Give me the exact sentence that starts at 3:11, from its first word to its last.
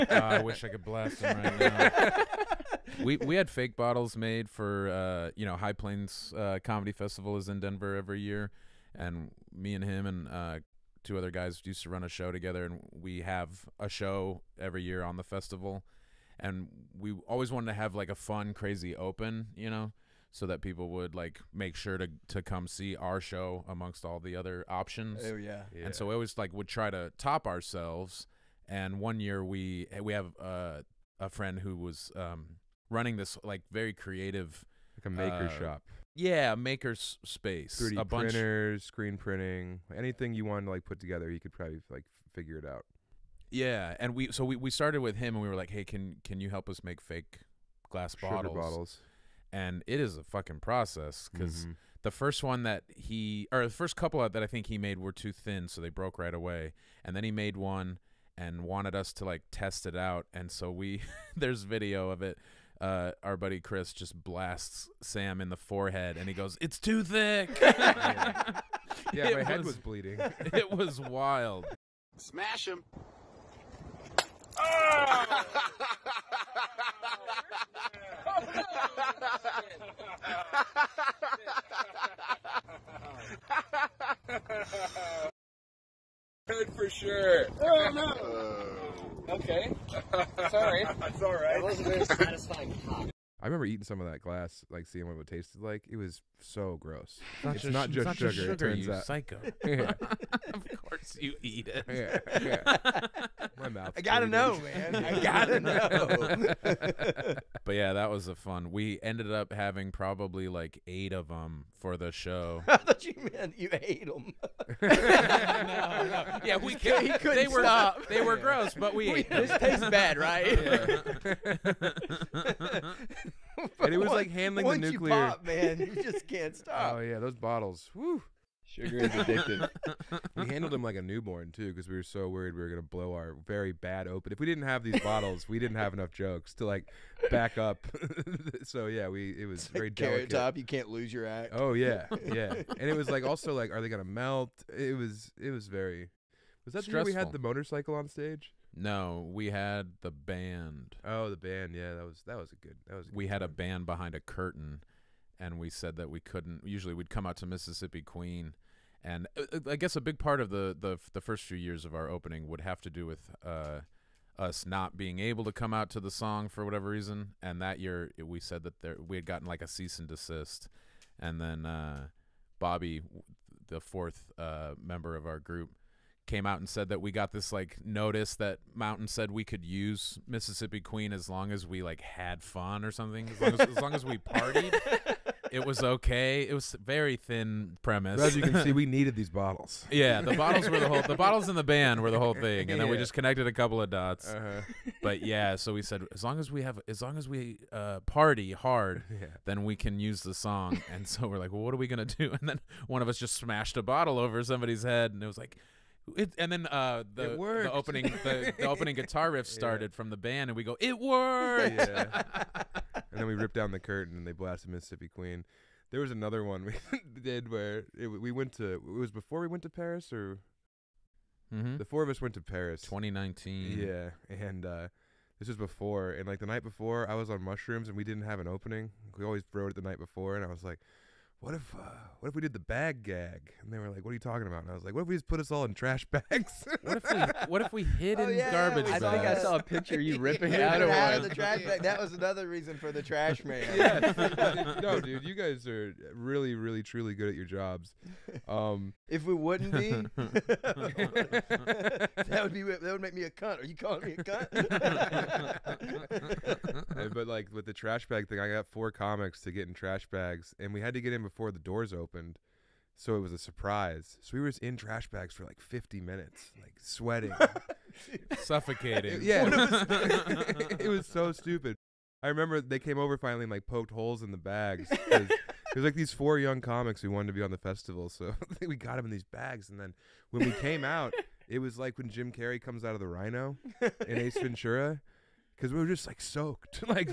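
The bottles in the band were the whole thing, and then we just connected a couple of dots.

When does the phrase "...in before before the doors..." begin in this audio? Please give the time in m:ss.
4:21.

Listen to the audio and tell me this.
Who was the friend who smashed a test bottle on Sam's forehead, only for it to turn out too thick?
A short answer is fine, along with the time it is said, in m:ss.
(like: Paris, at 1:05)
Chris, at 1:03.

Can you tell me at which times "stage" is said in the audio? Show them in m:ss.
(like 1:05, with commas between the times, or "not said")
2:28.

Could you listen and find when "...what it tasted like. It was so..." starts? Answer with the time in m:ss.
1:35.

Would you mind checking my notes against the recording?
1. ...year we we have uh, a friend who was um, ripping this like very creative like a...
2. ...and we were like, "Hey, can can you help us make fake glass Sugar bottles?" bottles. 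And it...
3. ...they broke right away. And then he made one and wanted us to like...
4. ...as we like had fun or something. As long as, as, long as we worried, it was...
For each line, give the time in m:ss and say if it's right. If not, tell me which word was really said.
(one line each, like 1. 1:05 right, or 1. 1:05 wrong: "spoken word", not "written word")
1. 0:29 wrong: "running", not "ripping"
2. 0:45 right
3. 0:55 right
4. 3:01 wrong: "partied", not "worried".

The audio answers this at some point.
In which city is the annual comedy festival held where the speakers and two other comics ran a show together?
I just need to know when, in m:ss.
0:07.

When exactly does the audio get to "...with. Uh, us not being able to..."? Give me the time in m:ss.
2:43.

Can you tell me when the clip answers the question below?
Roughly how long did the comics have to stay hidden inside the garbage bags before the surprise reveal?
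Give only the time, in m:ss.
4:25.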